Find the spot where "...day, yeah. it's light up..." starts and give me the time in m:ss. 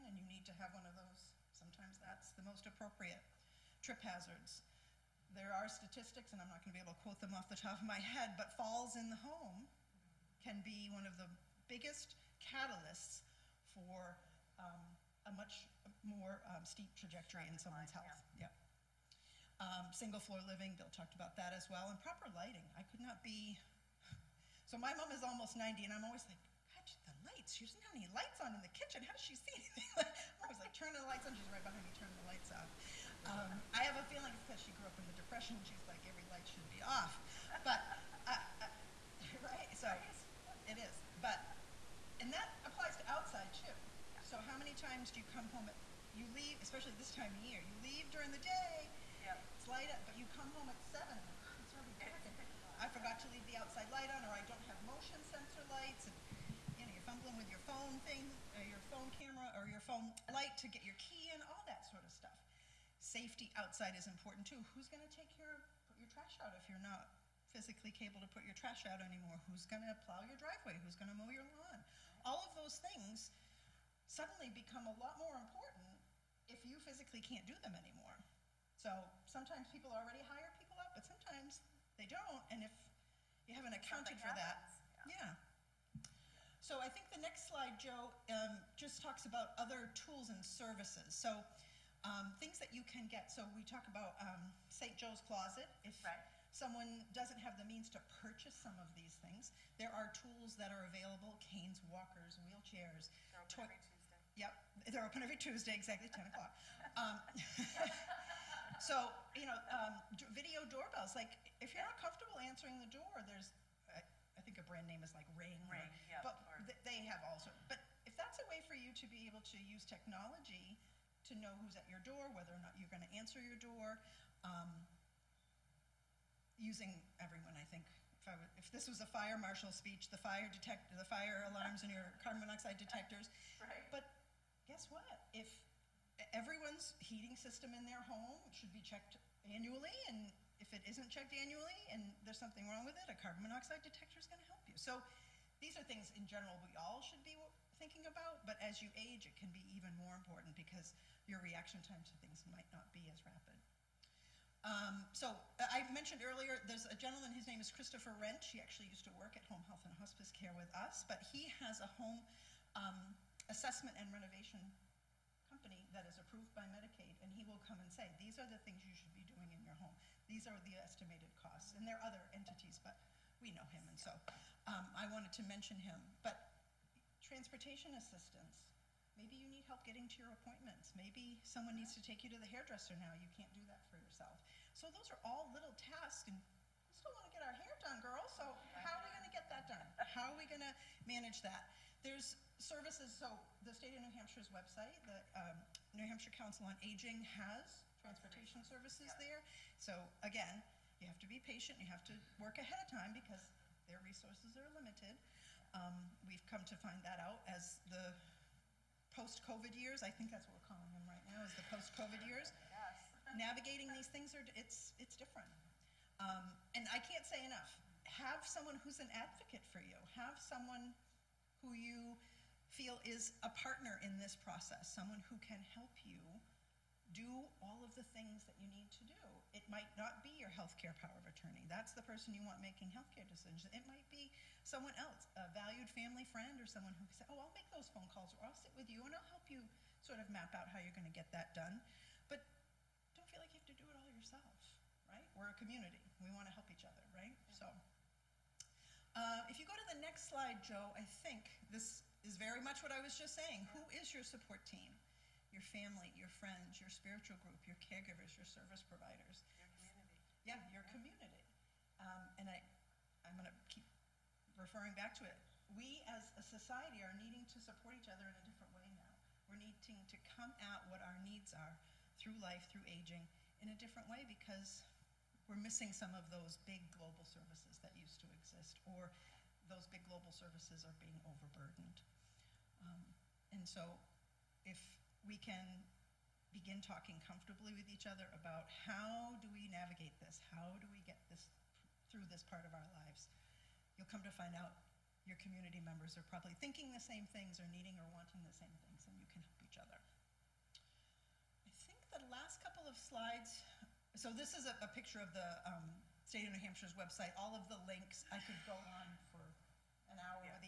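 0:48.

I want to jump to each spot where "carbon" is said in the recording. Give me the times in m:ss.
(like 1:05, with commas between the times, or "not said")
2:12, 2:23.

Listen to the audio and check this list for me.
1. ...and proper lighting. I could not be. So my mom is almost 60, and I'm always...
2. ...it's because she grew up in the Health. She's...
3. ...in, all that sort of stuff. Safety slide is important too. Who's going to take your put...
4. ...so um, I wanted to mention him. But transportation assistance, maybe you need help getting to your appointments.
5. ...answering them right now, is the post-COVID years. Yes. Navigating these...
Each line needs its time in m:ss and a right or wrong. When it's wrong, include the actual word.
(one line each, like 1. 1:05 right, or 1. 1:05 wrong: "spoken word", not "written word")
1. 0:21 wrong: "90", not "60"
2. 0:34 wrong: "Depression", not "Health"
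3. 1:01 wrong: "outside", not "slide"
4. 2:53 right
5. 3:30 wrong: "calling", not "answering".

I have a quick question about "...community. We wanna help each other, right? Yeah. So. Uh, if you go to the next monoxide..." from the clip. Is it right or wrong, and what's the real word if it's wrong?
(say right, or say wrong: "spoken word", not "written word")
wrong: "slide", not "monoxide".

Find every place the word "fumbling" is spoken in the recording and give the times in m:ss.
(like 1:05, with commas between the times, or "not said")
0:57.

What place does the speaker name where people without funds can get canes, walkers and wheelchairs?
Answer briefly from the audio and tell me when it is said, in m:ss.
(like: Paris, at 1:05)
St. Joe's Closet, at 1:34.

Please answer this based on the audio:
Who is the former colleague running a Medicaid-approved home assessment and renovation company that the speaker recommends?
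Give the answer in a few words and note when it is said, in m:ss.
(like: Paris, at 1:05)
Christopher Wrench, at 2:37.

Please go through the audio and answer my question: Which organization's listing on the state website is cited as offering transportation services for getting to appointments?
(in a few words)
New Hampshire Council on Aging.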